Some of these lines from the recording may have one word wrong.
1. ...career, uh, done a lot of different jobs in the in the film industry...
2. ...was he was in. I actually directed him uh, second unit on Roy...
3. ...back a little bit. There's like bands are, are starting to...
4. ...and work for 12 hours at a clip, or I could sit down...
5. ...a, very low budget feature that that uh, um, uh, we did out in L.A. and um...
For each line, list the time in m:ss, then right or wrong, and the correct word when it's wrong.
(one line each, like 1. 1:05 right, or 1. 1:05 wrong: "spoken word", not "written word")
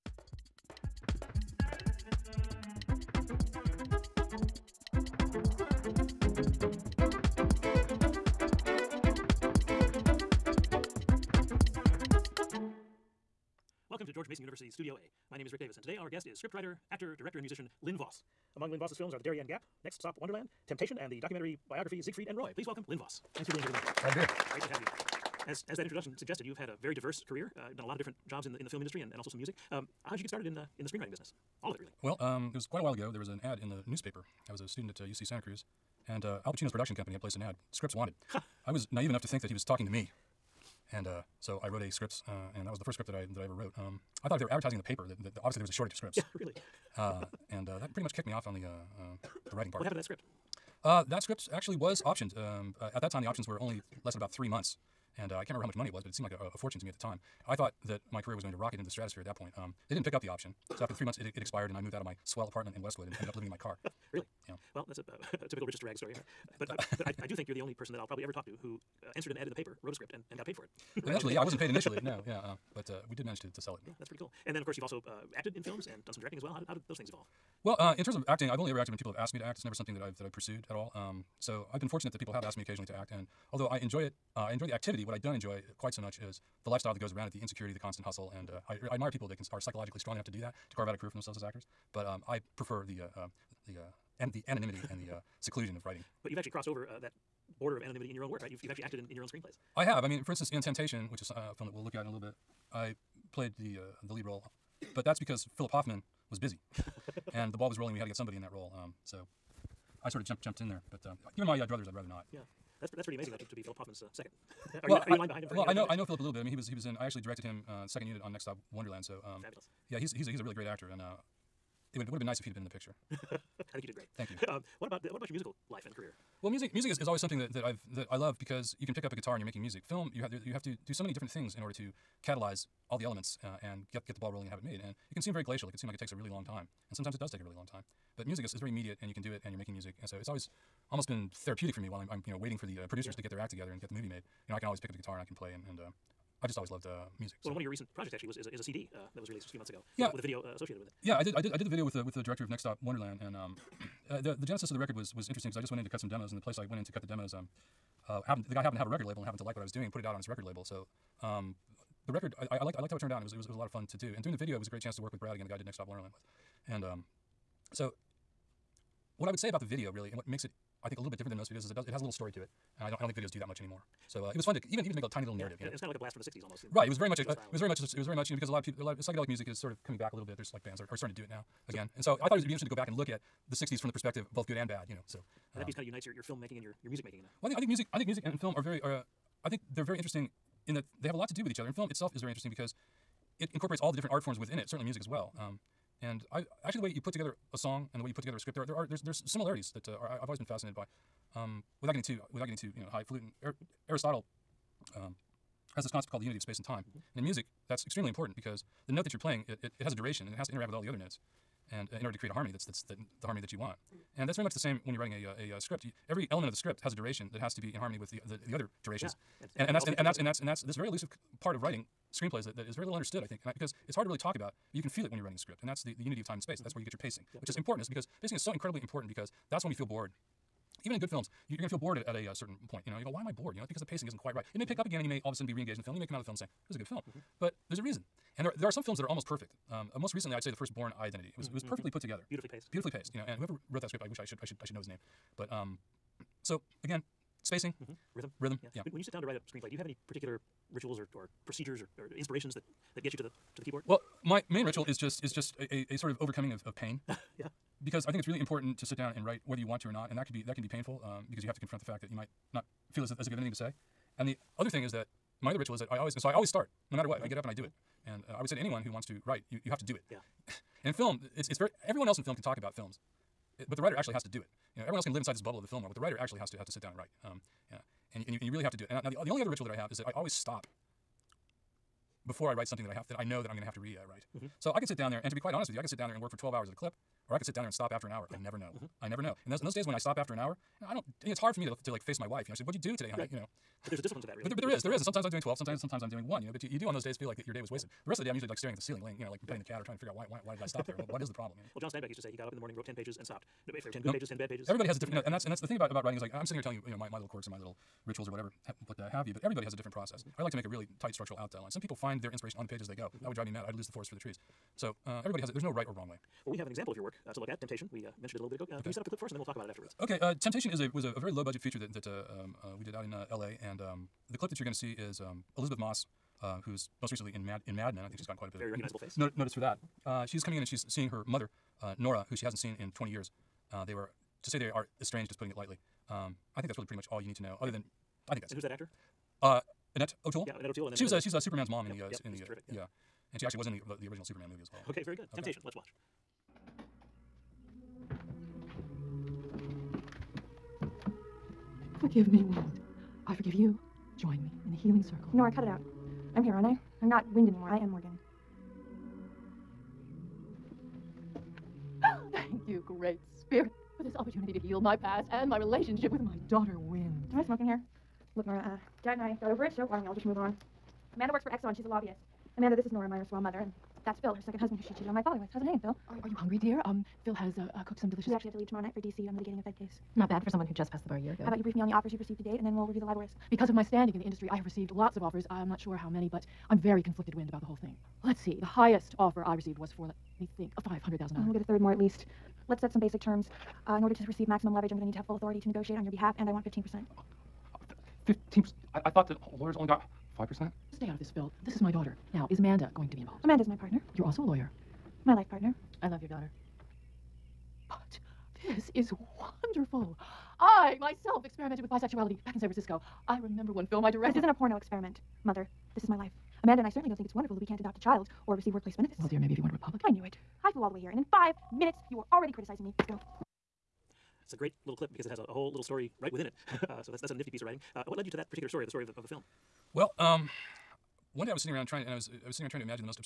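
1. 0:27 right
2. 1:56 wrong: "Next", not "Roy"
3. 2:59 right
4. 4:46 right
5. 5:21 right.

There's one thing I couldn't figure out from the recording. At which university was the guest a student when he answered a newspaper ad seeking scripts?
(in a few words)
UC Santa Cruz.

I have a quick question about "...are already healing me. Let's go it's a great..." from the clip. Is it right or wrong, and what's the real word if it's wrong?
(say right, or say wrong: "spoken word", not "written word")
wrong: "criticizing", not "healing".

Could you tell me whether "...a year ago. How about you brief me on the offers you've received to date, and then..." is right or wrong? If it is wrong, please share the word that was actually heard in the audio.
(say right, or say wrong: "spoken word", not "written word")
right.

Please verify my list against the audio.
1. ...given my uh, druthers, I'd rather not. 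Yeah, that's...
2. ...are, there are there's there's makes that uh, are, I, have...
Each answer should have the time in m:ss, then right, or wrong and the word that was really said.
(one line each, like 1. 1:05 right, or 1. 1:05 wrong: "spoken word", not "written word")
1. 1:51 right
2. 3:18 wrong: "similarities", not "makes".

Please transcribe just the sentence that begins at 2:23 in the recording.
to get their act together and get the movie made.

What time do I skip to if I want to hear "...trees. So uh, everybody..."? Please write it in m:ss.
5:14.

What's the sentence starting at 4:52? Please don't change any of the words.
You know, she said, "What'd you do today, honey?" Right.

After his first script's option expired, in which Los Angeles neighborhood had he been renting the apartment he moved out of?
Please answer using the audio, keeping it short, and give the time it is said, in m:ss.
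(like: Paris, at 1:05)
Westwood, at 1:02.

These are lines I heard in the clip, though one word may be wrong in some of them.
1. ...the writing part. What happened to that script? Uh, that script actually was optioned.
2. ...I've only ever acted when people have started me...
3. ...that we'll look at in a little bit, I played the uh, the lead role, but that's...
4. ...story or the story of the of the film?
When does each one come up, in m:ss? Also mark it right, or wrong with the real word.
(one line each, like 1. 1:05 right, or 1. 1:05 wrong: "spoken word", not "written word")
1. 0:49 right
2. 1:18 wrong: "asked", not "started"
3. 1:41 right
4. 7:08 right.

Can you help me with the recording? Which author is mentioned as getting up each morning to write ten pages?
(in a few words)
John Steinbeck.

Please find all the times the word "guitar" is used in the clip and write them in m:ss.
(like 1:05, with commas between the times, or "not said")
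2:09, 2:24.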